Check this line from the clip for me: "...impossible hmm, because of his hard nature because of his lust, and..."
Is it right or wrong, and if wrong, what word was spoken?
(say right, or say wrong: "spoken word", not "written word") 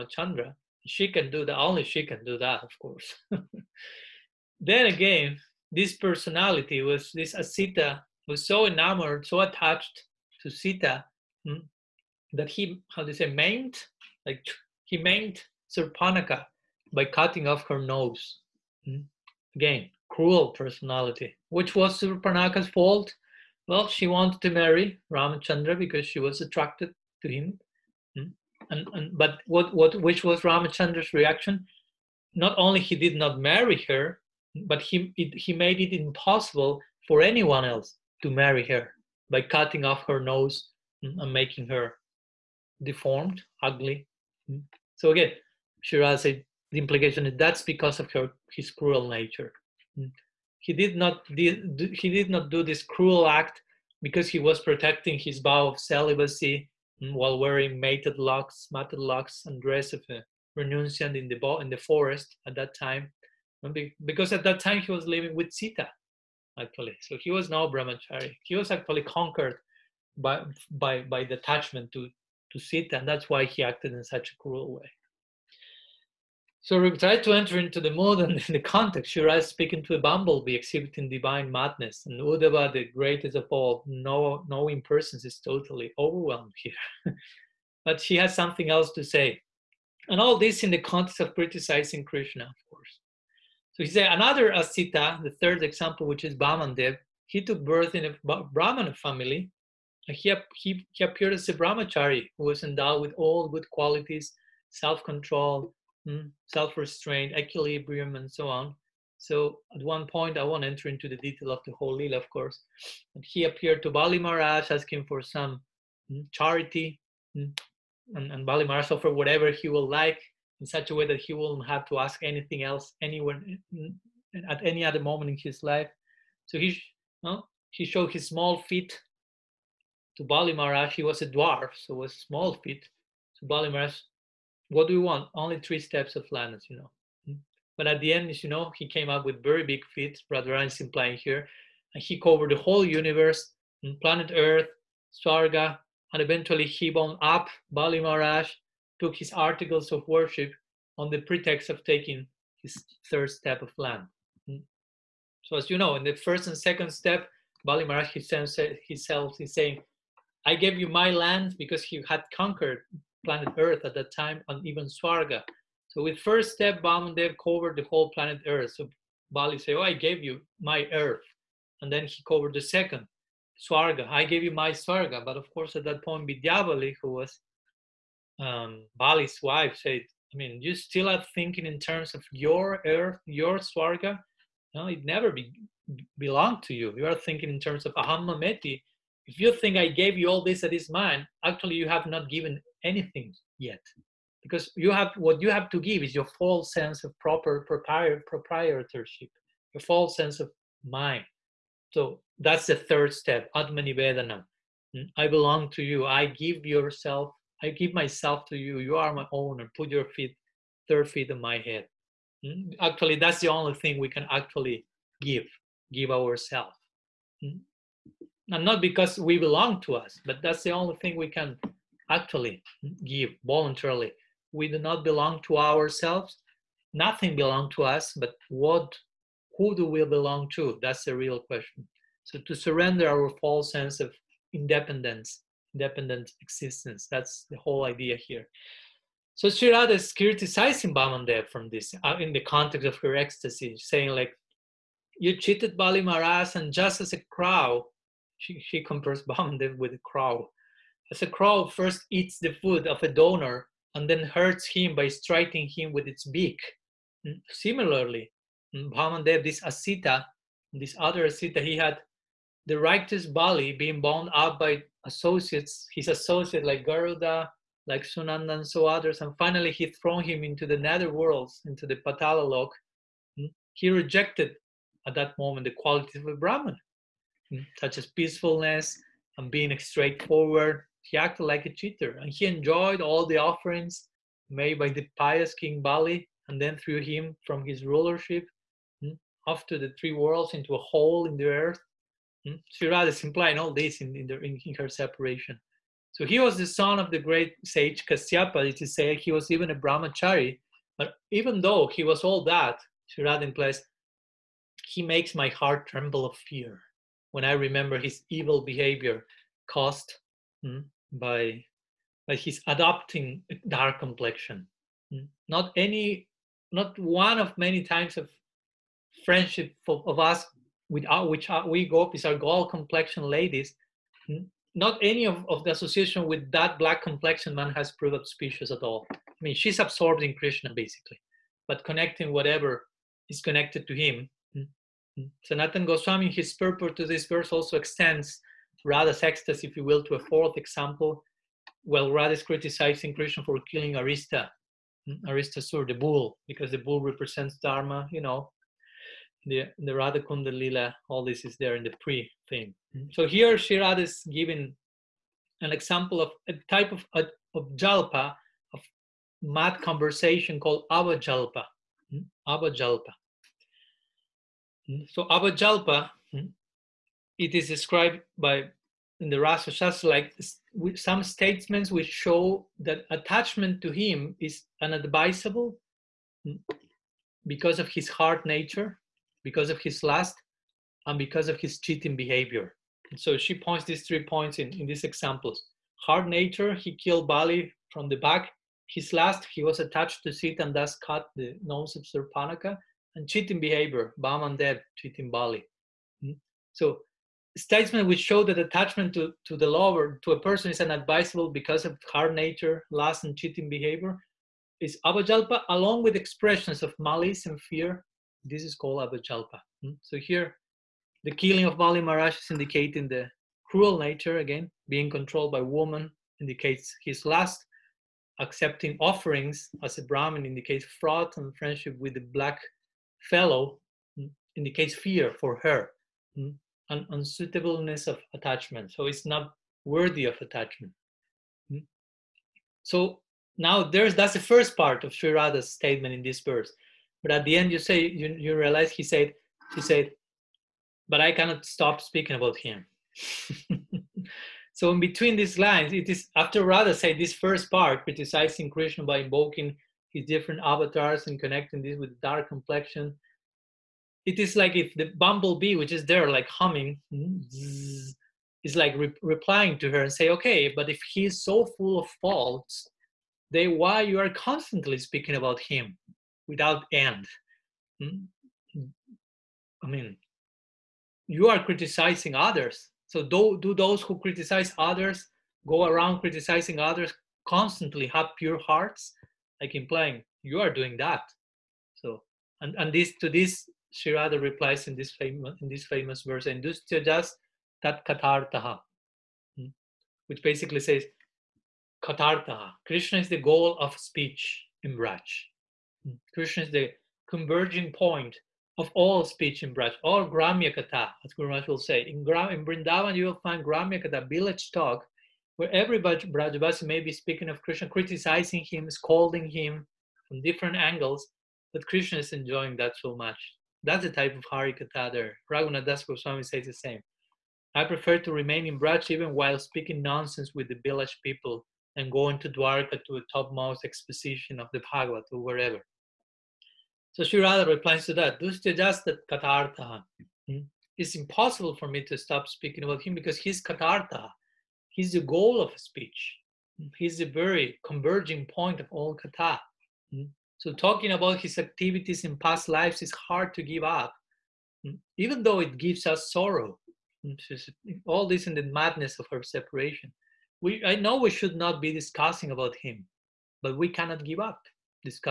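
wrong: "unadvisable", not "impossible".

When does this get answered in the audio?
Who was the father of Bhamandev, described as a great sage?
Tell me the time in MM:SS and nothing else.
04:58.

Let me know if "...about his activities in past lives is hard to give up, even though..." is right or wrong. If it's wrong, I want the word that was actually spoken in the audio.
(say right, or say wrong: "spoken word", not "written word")
right.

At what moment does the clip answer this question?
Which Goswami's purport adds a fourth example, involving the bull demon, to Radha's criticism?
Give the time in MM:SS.
05:35.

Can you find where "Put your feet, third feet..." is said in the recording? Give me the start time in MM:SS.
03:29.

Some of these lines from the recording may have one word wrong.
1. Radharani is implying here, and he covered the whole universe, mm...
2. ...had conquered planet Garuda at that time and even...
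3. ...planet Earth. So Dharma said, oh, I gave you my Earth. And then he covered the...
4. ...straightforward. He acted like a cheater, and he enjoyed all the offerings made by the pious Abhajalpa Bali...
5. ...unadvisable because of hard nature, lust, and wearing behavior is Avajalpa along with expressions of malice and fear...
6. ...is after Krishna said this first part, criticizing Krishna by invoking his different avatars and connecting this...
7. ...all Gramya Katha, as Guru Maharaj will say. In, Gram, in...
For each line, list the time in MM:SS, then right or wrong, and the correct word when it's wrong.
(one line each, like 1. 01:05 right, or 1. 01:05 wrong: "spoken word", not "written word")
1. 02:20 right
2. 02:42 wrong: "Earth", not "Garuda"
3. 02:48 wrong: "Bali", not "Dharma"
4. 04:39 wrong: "King", not "Abhajalpa"
5. 06:40 wrong: "cheating", not "wearing"
6. 07:26 wrong: "Radha", not "Krishna"
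7. 08:20 right.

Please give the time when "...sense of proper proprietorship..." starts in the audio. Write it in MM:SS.
03:16.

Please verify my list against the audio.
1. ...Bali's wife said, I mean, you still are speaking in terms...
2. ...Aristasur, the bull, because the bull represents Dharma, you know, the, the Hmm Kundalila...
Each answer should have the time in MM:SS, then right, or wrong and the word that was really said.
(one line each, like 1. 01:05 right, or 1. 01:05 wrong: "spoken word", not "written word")
1. 02:58 wrong: "thinking", not "speaking"
2. 05:45 wrong: "Radha", not "Hmm".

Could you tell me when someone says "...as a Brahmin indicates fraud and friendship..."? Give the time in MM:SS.
06:59.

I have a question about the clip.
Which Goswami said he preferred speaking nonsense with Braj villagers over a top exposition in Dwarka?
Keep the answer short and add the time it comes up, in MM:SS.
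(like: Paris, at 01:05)
Raghunath Das Goswami, at 08:35.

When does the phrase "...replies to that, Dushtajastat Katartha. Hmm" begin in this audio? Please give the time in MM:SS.
08:47.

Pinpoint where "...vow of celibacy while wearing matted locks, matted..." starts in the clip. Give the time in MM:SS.
00:55.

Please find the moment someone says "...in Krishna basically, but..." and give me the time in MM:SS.
05:30.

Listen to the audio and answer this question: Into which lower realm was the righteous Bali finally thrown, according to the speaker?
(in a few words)
Patala lok.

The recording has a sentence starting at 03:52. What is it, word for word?
So to surrender our false sense of independence Independent existence.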